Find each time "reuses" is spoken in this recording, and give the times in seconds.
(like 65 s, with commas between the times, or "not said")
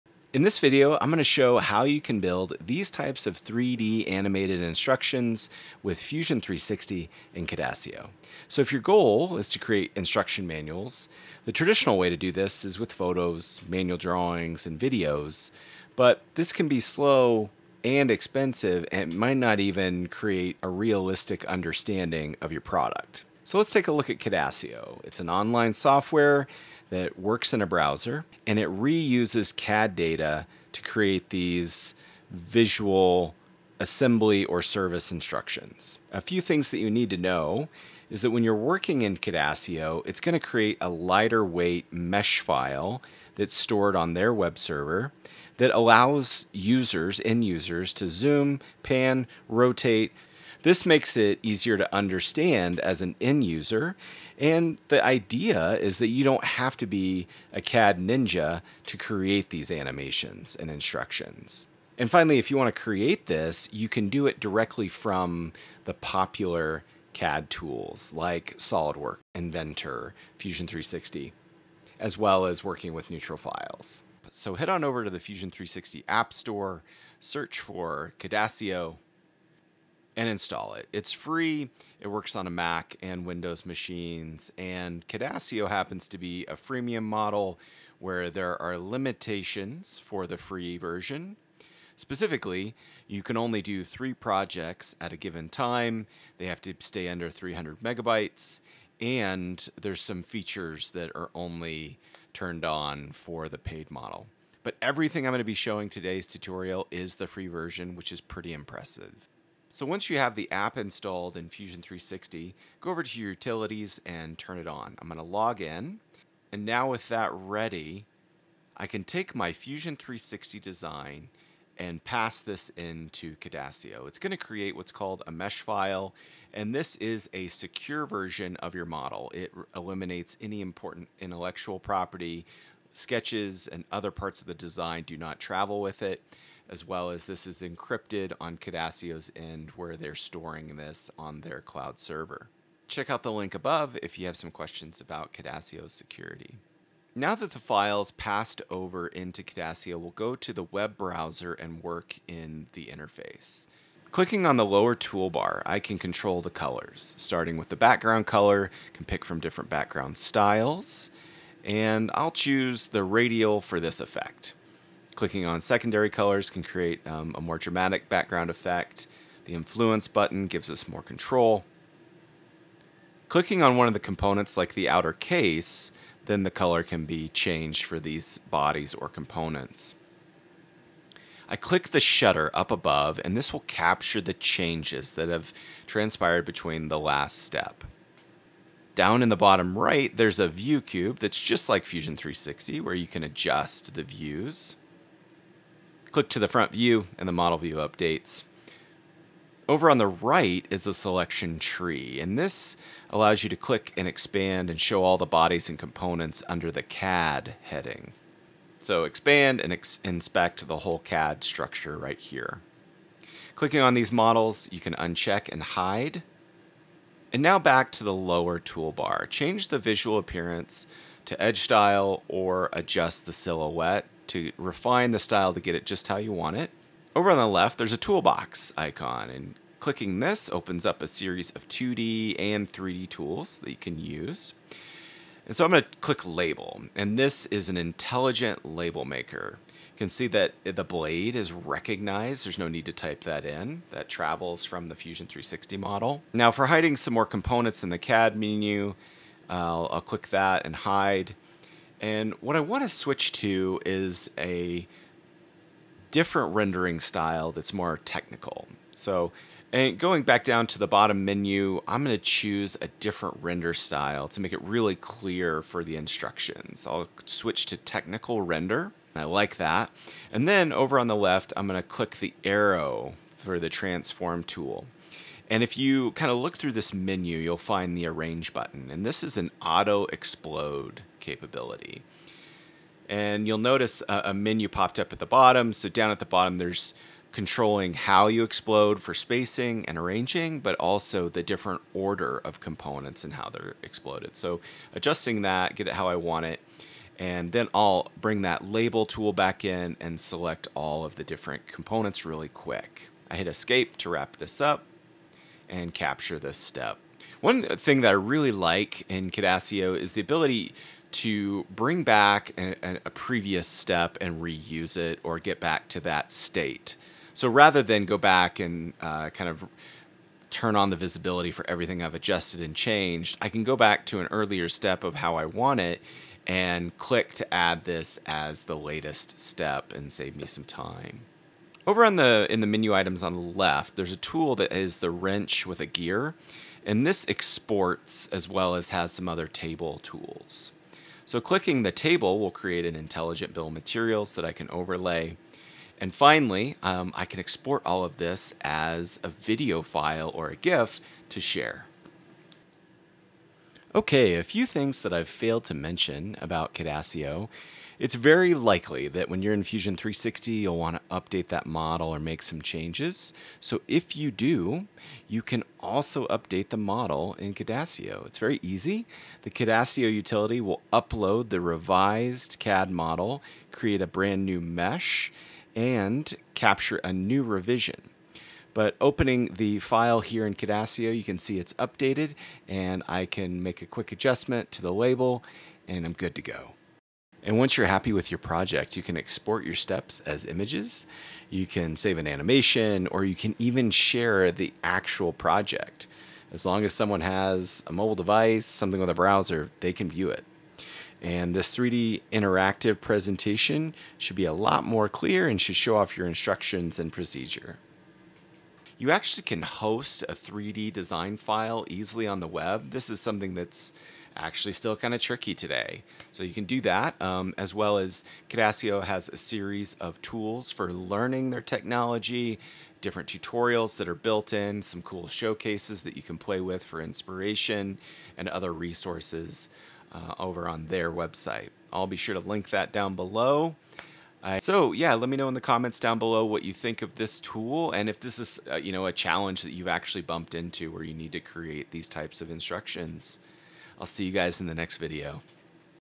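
28 s, 314 s.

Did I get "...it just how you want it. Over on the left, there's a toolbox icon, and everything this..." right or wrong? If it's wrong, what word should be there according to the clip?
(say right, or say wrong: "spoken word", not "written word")
wrong: "clicking", not "everything".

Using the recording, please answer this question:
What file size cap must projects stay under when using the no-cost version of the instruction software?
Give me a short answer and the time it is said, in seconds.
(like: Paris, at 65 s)
300 megabytes, at 97 s.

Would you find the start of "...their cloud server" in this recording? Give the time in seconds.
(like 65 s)
141 s.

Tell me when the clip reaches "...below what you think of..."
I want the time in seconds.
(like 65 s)
436 s.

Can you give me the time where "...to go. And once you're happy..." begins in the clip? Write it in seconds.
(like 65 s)
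386 s.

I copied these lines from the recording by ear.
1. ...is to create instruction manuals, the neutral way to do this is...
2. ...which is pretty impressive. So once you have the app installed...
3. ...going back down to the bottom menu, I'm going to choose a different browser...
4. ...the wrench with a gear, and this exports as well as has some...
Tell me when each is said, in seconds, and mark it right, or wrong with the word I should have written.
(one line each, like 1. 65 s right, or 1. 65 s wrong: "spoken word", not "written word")
1. 9 s wrong: "traditional", not "neutral"
2. 107 s right
3. 259 s wrong: "render", not "browser"
4. 334 s right.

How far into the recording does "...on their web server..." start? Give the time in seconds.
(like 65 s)
43 s.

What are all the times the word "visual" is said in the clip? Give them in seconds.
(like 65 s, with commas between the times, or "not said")
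32 s, 219 s.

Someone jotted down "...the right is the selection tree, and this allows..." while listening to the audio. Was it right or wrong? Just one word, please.
right.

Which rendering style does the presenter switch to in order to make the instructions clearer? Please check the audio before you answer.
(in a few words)
Technical render.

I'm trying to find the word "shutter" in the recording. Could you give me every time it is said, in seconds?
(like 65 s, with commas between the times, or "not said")
181 s.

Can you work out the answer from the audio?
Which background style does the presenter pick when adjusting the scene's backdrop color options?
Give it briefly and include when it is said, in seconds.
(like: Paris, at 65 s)
Radial, at 163 s.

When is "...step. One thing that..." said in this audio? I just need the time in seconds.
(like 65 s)
306 s.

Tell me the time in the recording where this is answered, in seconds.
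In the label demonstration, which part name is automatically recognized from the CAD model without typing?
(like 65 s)
240 s.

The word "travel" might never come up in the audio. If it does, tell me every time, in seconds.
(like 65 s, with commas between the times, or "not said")
135 s, 244 s.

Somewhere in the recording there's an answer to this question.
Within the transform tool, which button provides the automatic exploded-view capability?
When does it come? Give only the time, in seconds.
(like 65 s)
278 s.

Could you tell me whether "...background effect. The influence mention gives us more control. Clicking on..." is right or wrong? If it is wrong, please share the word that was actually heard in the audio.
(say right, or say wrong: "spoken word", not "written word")
wrong: "button", not "mention".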